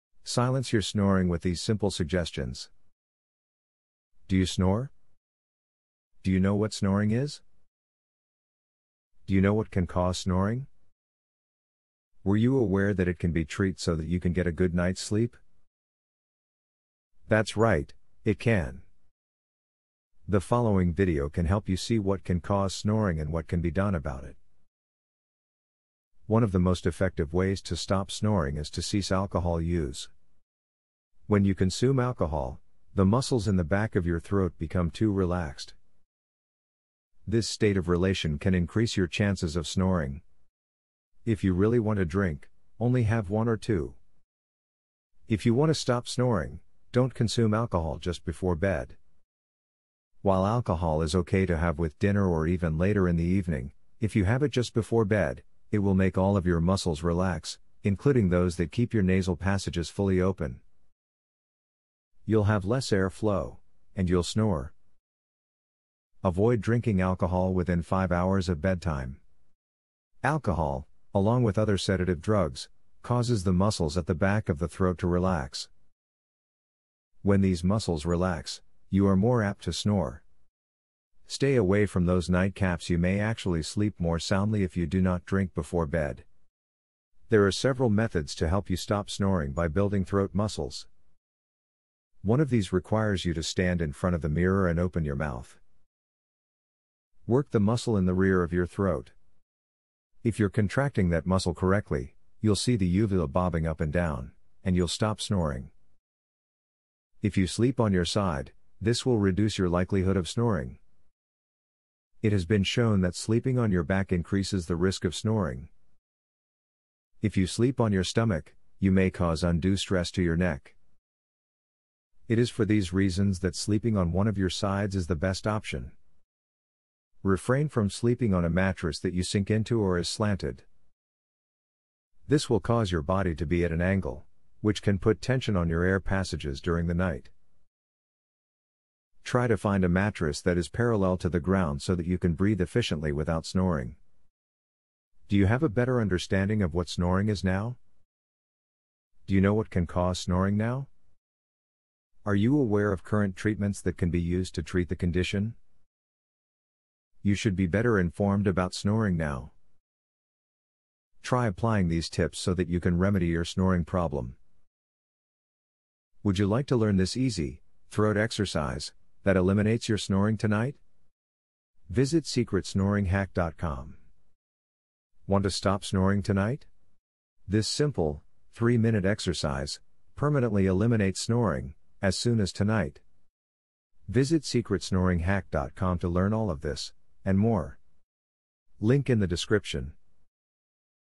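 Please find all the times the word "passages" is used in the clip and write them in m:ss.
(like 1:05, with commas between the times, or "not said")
0:59, 2:15.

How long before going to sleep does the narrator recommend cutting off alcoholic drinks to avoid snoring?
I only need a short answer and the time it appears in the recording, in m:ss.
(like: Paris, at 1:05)
5 hours, at 1:07.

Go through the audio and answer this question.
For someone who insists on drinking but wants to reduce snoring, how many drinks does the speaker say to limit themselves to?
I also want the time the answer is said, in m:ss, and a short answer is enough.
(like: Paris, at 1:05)
1 or 2, at 0:43.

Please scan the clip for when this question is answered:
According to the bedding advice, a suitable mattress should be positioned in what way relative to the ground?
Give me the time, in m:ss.
2:20.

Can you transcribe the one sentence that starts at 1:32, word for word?
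One of these requires you to stand in front of the mirror and open your mouth.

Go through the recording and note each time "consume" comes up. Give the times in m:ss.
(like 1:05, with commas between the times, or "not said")
0:31, 0:47.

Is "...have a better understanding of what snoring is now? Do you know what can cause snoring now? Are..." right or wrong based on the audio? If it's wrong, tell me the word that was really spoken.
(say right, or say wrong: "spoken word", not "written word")
right.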